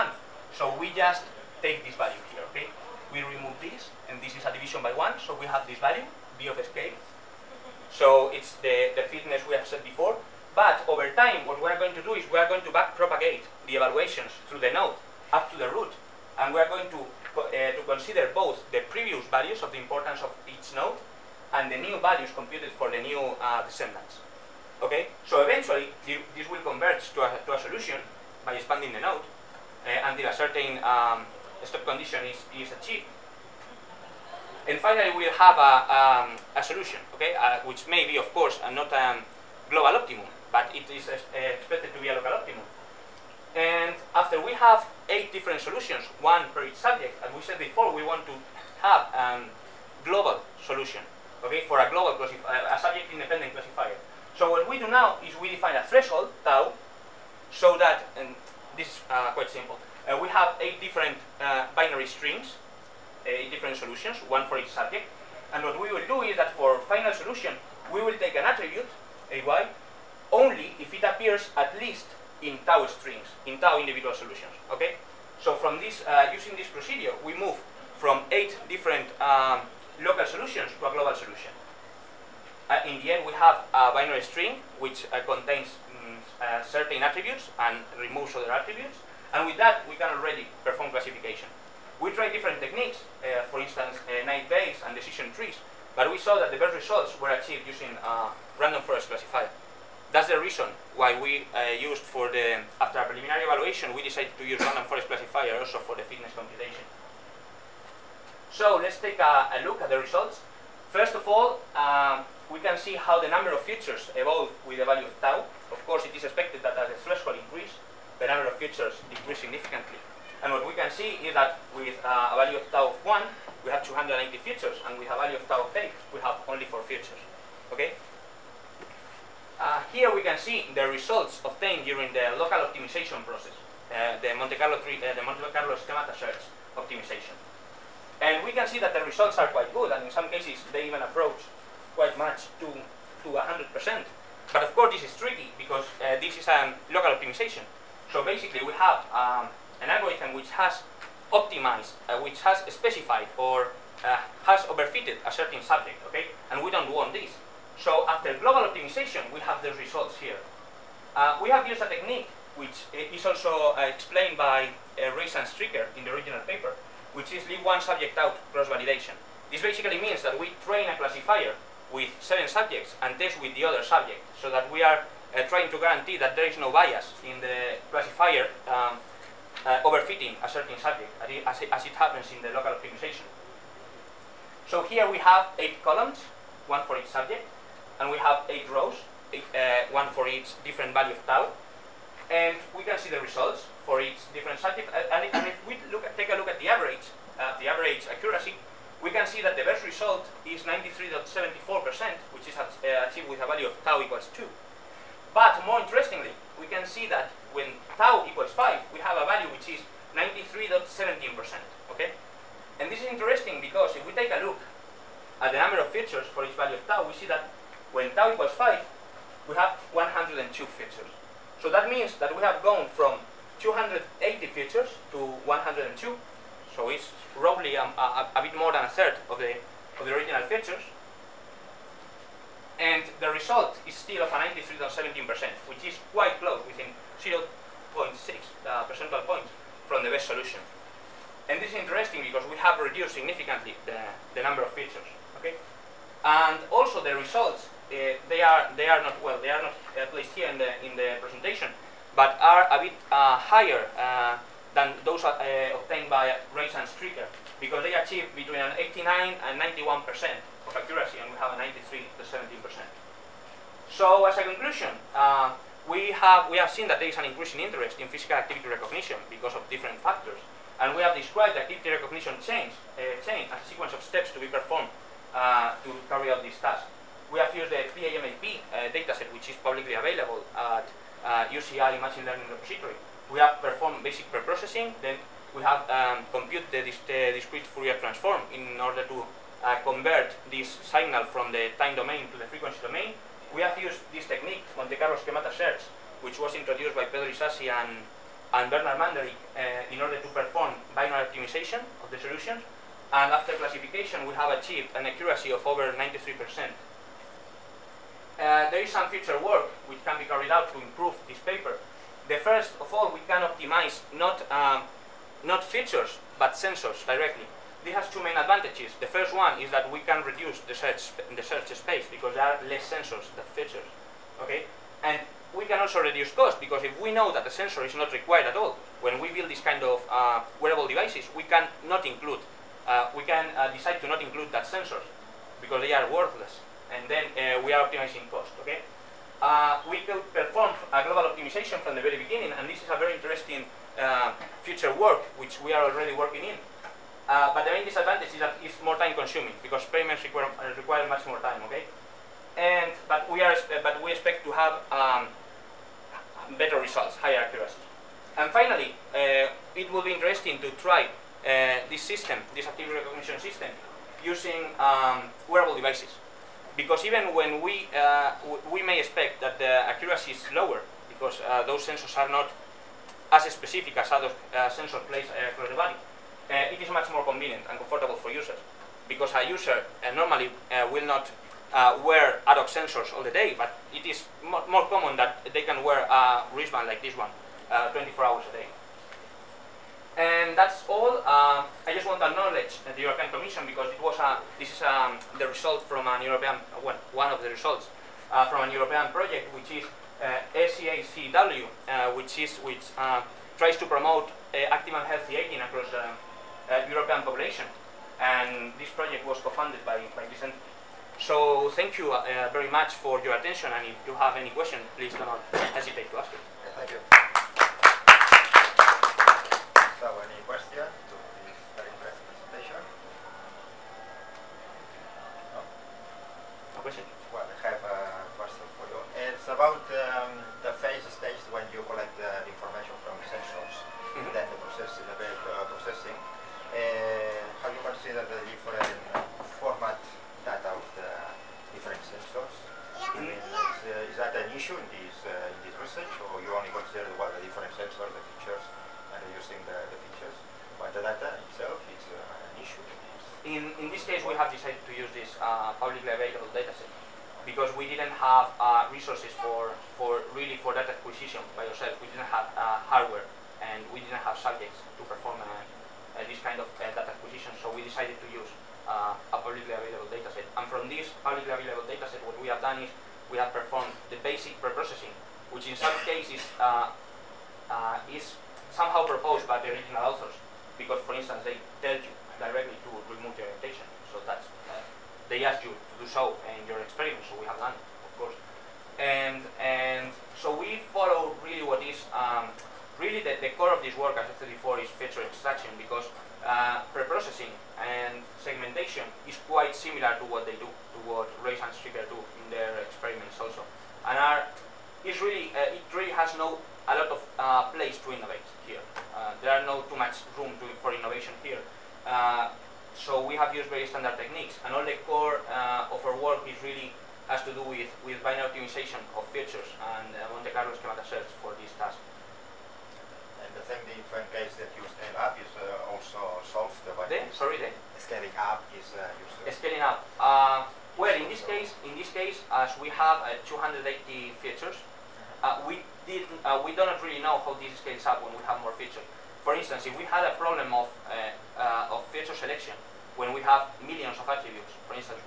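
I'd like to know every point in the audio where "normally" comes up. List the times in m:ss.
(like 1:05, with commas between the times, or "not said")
6:20.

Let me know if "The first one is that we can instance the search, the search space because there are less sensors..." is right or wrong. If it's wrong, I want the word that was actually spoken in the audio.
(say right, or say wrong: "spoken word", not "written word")
wrong: "reduce", not "instance".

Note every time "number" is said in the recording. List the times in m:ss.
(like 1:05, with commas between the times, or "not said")
1:53, 1:58, 3:35, 4:04.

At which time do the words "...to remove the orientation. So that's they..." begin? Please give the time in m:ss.
8:02.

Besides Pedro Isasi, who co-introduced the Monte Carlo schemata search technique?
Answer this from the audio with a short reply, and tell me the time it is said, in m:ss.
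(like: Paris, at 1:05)
Bernard Manderick, at 4:58.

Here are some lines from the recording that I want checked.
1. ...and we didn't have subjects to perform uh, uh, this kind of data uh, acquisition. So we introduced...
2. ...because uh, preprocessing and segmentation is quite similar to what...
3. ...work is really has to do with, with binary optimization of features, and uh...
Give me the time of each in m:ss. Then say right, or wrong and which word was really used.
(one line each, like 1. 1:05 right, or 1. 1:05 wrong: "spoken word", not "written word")
1. 7:43 wrong: "decided", not "introduced"
2. 8:15 right
3. 8:36 right.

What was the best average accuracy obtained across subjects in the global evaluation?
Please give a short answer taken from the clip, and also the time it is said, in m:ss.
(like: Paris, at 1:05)
93.74%, at 3:20.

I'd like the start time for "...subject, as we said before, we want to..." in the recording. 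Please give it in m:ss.
0:46.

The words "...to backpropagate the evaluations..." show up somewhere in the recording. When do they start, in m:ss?
0:12.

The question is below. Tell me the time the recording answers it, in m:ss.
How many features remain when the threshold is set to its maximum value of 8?
2:06.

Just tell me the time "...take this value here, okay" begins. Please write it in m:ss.
0:01.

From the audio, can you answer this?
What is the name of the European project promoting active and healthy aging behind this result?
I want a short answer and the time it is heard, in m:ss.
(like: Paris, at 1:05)
SEACW, at 6:40.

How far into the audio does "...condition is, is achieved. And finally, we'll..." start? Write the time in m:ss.
0:31.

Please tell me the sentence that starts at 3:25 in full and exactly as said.
But more interestingly, we can see that when tau equals 5, we have a value which is 93.17%, okay?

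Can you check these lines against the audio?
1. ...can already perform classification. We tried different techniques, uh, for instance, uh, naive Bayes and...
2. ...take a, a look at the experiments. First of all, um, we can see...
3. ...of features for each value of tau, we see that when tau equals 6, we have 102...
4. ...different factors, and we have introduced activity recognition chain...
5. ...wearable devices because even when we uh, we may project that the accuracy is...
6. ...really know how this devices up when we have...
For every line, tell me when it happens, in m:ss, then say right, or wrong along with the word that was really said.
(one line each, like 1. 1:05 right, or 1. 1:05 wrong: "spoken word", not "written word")
1. 1:29 right
2. 1:48 wrong: "results", not "experiments"
3. 3:35 wrong: "5", not "6"
4. 4:29 wrong: "described", not "introduced"
5. 6:05 wrong: "expect", not "project"
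6. 8:56 wrong: "scales", not "devices".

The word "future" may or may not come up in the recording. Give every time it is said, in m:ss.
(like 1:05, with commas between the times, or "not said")
5:09, 5:44.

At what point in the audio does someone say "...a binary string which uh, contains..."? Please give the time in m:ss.
1:23.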